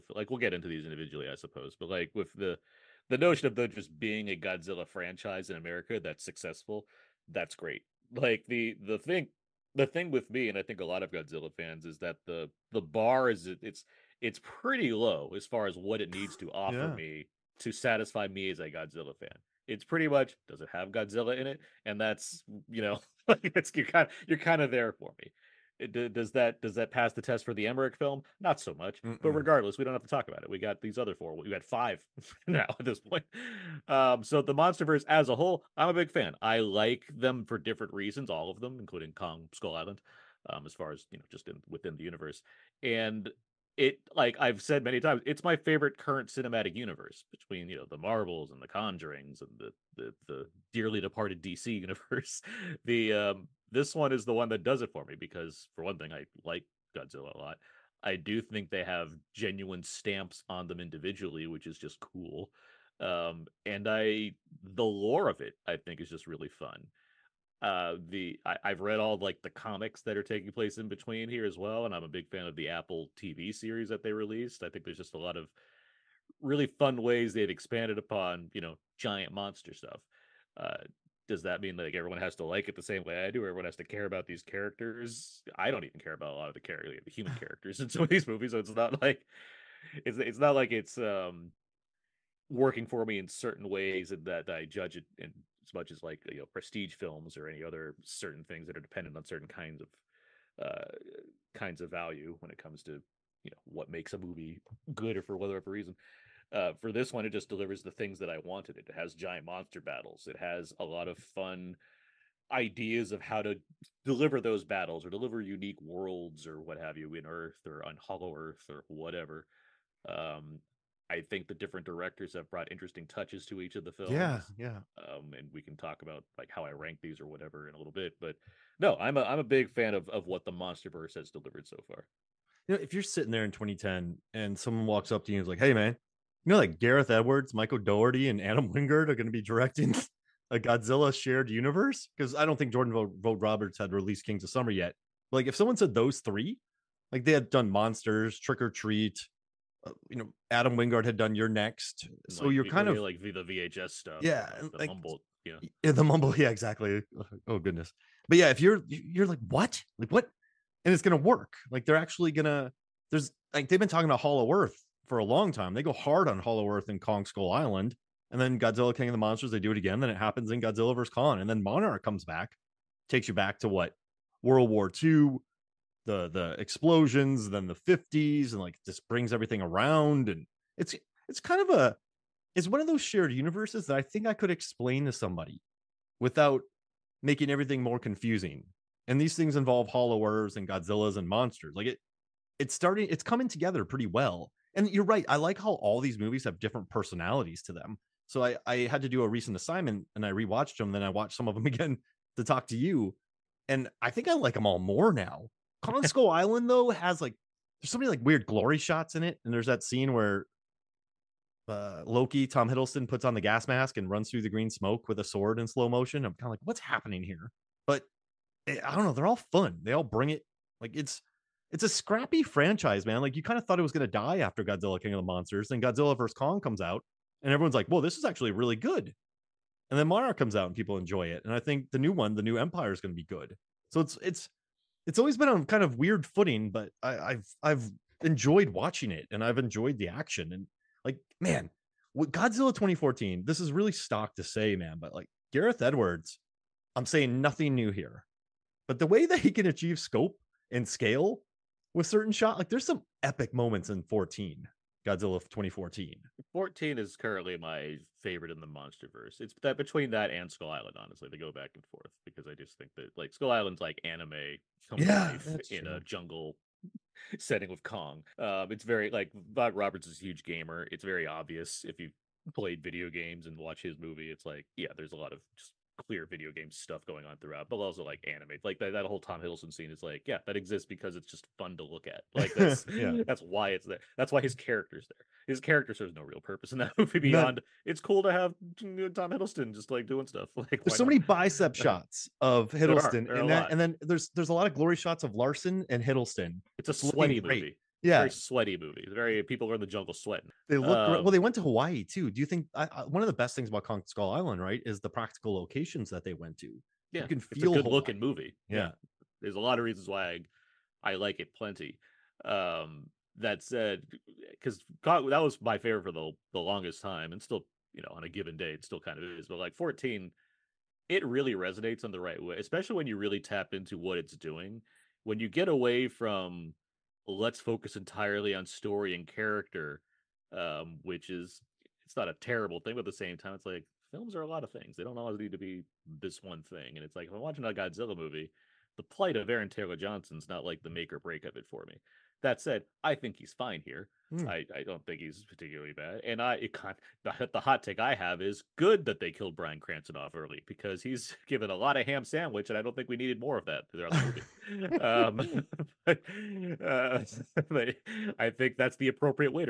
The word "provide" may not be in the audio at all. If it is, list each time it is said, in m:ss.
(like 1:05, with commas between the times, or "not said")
not said.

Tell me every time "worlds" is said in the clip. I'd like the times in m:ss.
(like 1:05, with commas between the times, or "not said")
1:55, 2:54.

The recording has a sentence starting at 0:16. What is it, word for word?
me to satisfy me as a Godzilla fan.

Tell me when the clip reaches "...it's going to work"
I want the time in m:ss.
2:40.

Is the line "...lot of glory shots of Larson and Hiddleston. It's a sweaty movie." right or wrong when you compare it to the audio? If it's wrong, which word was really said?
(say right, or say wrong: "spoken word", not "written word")
right.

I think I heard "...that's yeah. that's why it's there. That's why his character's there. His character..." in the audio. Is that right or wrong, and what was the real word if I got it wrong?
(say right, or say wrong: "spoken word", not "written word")
right.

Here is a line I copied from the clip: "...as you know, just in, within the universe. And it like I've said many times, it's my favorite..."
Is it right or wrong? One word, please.
right.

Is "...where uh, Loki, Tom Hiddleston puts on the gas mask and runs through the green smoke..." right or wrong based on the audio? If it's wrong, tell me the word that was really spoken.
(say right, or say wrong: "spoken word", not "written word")
right.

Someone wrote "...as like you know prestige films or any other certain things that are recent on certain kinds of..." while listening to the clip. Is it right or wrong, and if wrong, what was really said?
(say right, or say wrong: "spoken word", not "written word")
wrong: "dependent", not "recent".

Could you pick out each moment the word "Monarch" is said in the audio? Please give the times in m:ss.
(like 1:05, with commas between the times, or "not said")
2:51.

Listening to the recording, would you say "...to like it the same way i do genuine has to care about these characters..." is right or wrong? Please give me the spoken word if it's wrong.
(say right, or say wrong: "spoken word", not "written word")
wrong: "everyone", not "genuine".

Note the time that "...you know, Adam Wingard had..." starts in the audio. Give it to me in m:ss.
2:30.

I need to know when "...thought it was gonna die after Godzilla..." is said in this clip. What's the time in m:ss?
3:43.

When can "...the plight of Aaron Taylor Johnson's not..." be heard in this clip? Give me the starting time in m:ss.
5:38.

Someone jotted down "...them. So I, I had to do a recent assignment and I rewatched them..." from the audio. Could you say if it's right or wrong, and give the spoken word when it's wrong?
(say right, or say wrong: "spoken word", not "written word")
right.